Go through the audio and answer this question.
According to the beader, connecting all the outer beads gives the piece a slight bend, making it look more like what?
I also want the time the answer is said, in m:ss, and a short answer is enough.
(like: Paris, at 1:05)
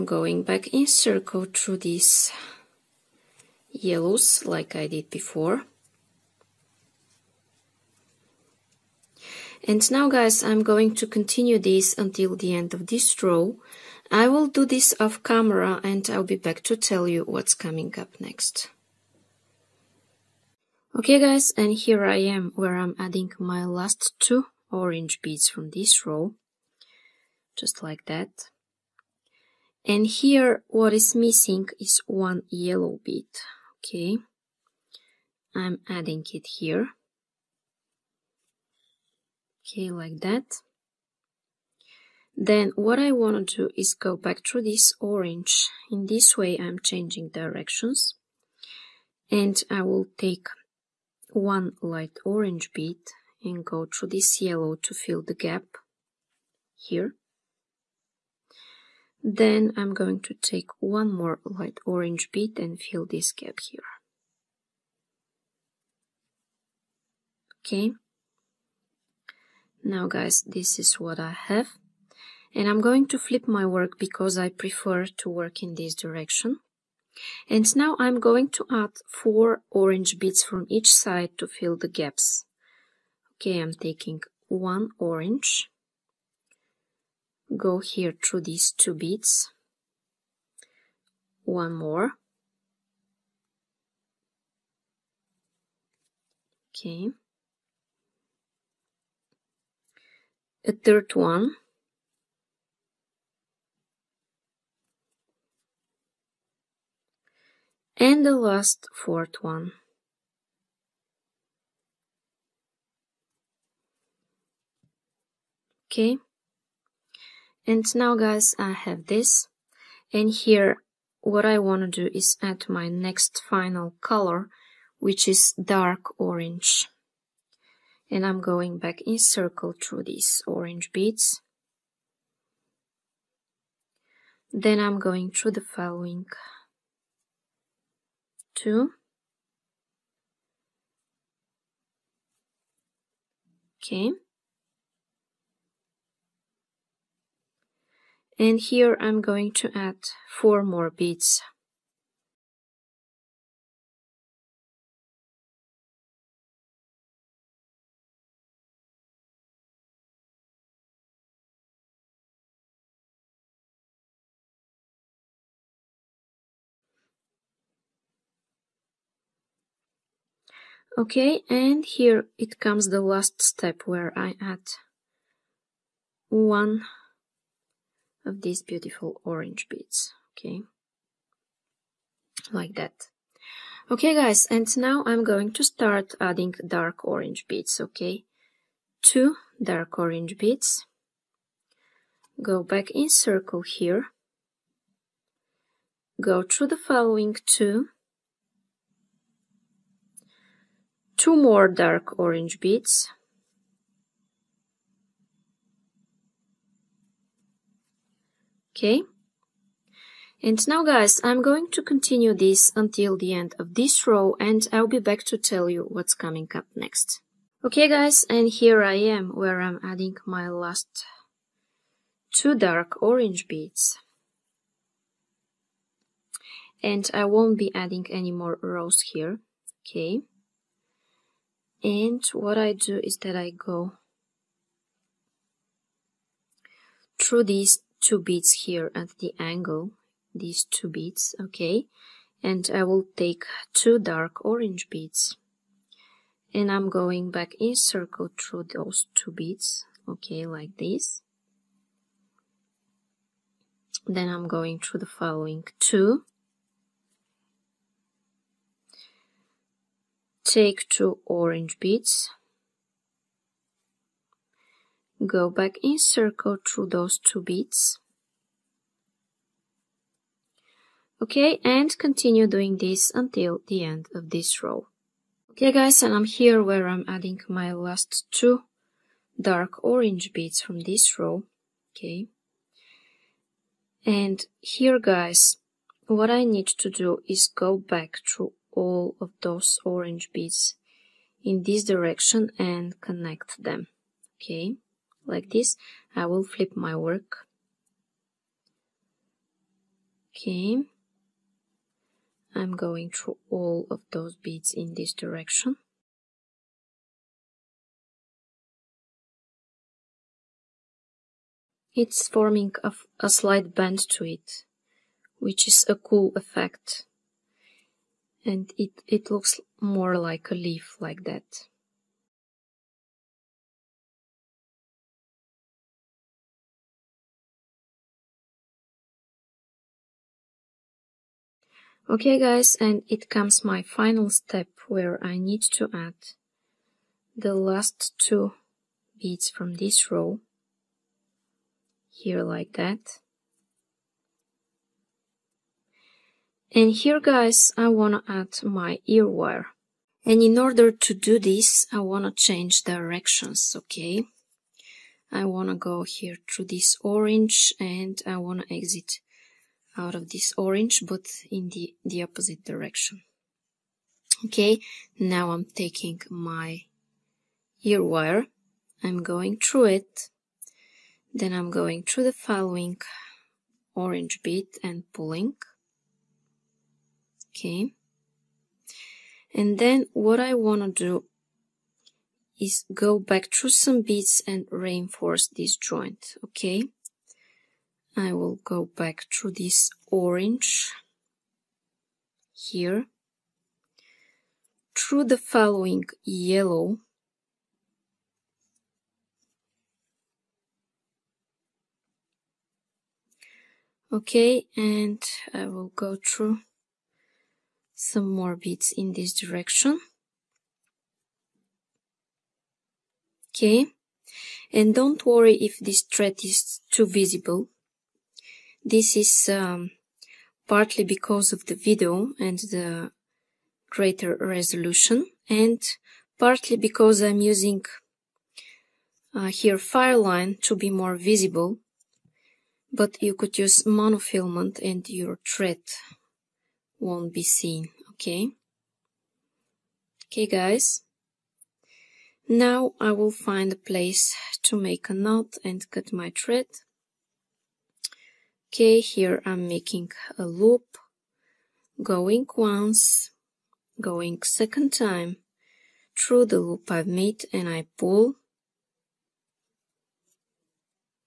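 A leaf, at 5:20.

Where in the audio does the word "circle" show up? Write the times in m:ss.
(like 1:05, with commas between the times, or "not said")
0:00, 2:09, 3:13, 4:07, 4:25.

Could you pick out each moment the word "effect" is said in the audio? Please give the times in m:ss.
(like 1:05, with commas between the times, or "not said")
5:16.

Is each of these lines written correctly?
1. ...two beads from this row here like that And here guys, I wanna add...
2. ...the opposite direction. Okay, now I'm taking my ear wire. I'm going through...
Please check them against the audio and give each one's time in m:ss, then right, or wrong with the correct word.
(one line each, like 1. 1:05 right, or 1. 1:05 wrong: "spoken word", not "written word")
1. 5:38 right
2. 6:02 right.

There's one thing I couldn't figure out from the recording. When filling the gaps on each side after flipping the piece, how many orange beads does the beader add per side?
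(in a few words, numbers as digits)
4.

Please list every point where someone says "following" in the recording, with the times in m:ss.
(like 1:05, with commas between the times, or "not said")
2:15, 3:16, 4:15, 6:12, 6:35.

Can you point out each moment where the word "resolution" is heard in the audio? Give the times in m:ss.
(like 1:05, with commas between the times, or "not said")
7:04.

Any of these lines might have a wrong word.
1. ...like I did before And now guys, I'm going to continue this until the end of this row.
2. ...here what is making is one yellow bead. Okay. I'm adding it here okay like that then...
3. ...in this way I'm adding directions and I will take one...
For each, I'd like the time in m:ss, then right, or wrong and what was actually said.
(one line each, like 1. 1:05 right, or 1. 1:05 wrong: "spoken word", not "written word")
1. 0:04 right
2. 0:30 wrong: "missing", not "making"
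3. 0:45 wrong: "changing", not "adding".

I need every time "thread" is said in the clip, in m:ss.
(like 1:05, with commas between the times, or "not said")
6:56, 7:15, 7:26.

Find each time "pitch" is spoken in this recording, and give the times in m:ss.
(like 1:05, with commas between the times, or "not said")
not said.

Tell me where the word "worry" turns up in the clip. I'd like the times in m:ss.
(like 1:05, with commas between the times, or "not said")
6:55.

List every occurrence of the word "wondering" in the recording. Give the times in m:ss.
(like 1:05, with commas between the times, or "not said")
not said.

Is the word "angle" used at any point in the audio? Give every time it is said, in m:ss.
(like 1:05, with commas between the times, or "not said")
3:59.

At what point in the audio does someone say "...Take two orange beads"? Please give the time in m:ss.
4:20.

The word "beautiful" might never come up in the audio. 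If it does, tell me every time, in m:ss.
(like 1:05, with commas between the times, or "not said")
2:58.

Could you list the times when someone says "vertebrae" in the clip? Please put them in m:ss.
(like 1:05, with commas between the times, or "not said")
not said.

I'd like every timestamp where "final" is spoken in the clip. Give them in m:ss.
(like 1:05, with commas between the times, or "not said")
2:03, 5:33.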